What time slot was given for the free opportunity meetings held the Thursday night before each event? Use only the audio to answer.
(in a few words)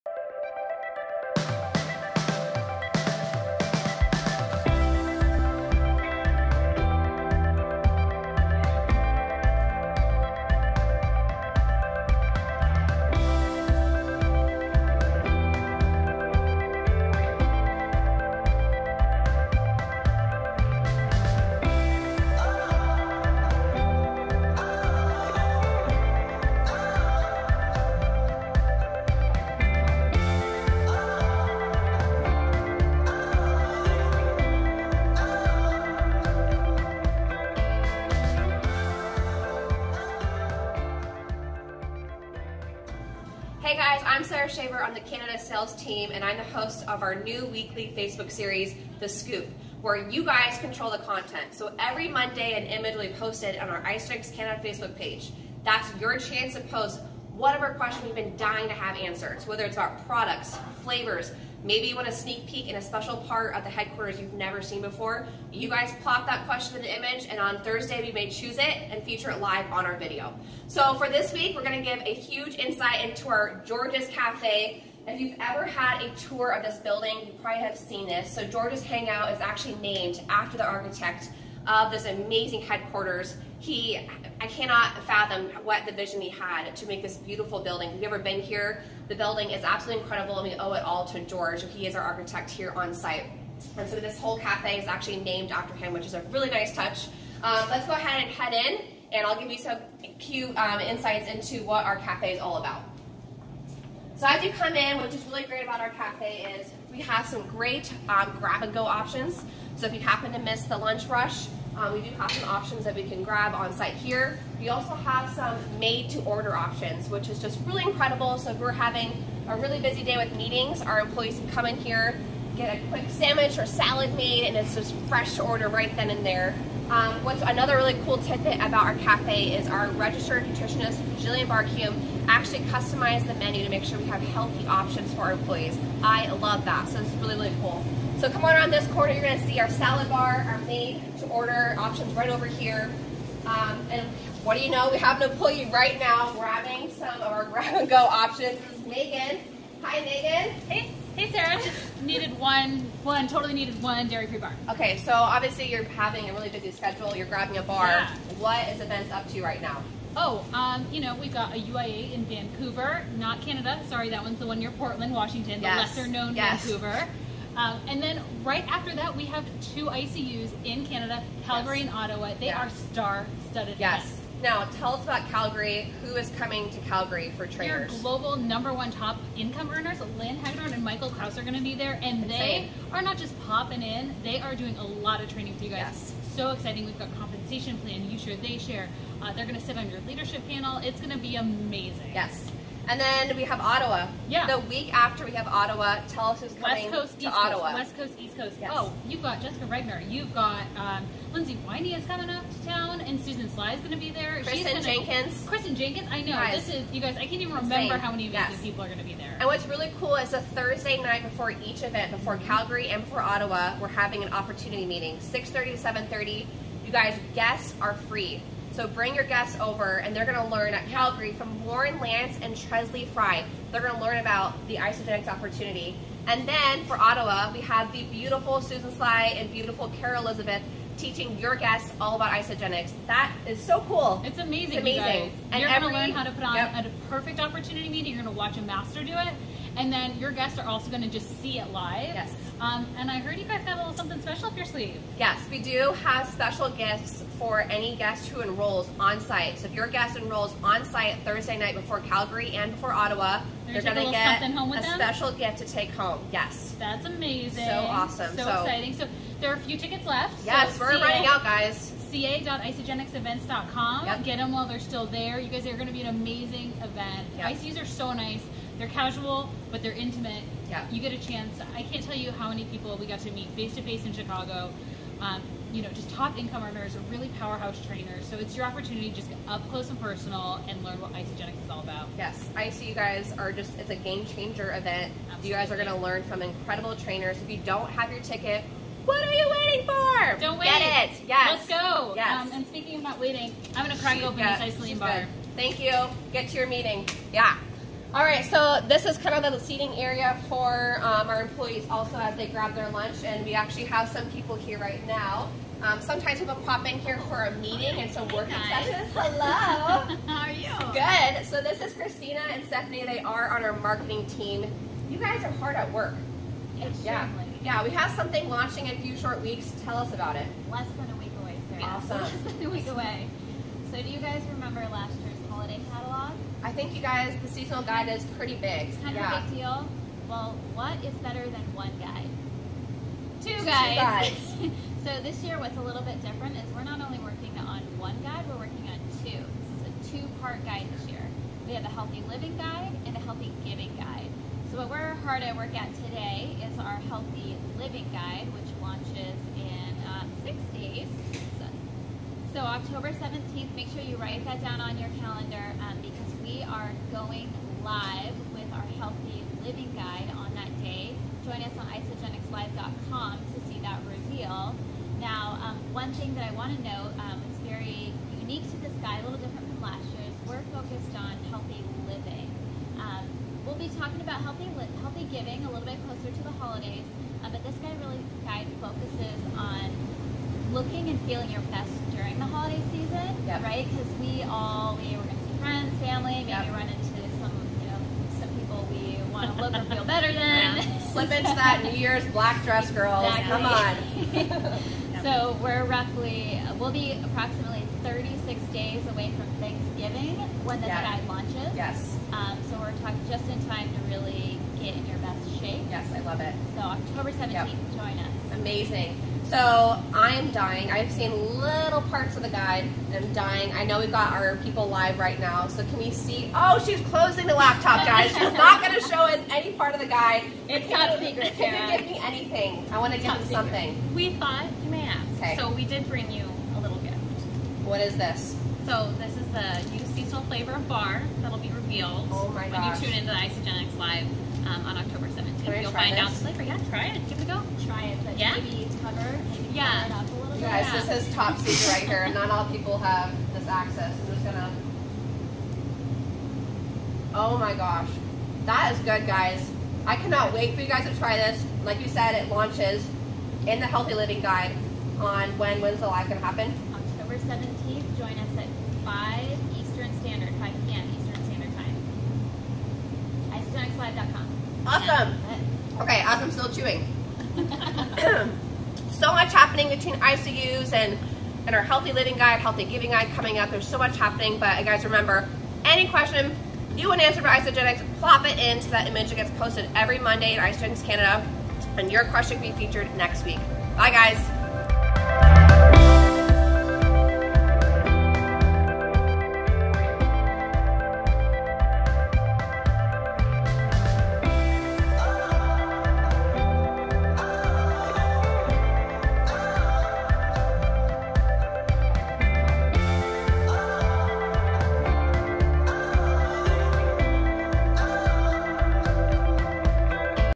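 6:30 to 7:30.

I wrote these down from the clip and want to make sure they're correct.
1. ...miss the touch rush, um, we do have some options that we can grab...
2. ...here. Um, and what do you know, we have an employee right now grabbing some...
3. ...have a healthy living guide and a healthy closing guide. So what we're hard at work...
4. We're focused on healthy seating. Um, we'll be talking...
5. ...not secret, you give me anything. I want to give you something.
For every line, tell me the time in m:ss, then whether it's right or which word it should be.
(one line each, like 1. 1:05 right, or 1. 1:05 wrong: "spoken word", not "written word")
1. 1:50 wrong: "lunch", not "touch"
2. 2:22 right
3. 5:41 wrong: "giving", not "closing"
4. 6:10 wrong: "living", not "seating"
5. 7:00 right.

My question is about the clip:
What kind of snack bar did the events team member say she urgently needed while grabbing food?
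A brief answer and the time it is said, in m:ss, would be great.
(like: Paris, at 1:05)
Dairy-free bar, at 2:34.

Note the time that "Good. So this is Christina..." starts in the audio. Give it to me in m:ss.
5:10.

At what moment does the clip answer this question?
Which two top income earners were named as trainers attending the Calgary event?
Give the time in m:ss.
3:00.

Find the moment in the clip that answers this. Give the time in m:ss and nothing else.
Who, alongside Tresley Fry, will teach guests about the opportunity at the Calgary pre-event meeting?
3:41.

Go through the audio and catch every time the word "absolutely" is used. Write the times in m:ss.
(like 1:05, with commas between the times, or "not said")
1:29, 4:45.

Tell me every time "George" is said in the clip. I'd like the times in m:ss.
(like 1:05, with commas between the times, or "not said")
1:13, 1:18, 1:31.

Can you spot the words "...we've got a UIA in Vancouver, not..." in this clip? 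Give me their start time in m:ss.
2:41.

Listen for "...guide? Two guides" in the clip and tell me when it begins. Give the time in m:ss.
5:31.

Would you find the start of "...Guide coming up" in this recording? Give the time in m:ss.
7:53.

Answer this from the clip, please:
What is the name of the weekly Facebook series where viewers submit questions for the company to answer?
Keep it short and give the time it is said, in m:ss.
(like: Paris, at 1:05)
The Scoop, at 0:48.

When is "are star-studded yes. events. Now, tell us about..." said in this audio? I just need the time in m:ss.
2:52.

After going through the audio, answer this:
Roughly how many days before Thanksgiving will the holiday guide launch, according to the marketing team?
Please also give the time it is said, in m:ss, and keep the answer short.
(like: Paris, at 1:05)
36 days, at 6:38.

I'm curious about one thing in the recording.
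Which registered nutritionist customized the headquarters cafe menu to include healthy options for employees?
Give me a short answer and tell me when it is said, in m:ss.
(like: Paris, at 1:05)
Jillian Barcume, at 2:11.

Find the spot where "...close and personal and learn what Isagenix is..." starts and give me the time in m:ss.
4:39.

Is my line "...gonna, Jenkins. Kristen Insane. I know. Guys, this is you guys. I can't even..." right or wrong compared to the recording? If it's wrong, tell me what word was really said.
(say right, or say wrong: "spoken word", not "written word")
wrong: "Jenkins", not "Insane".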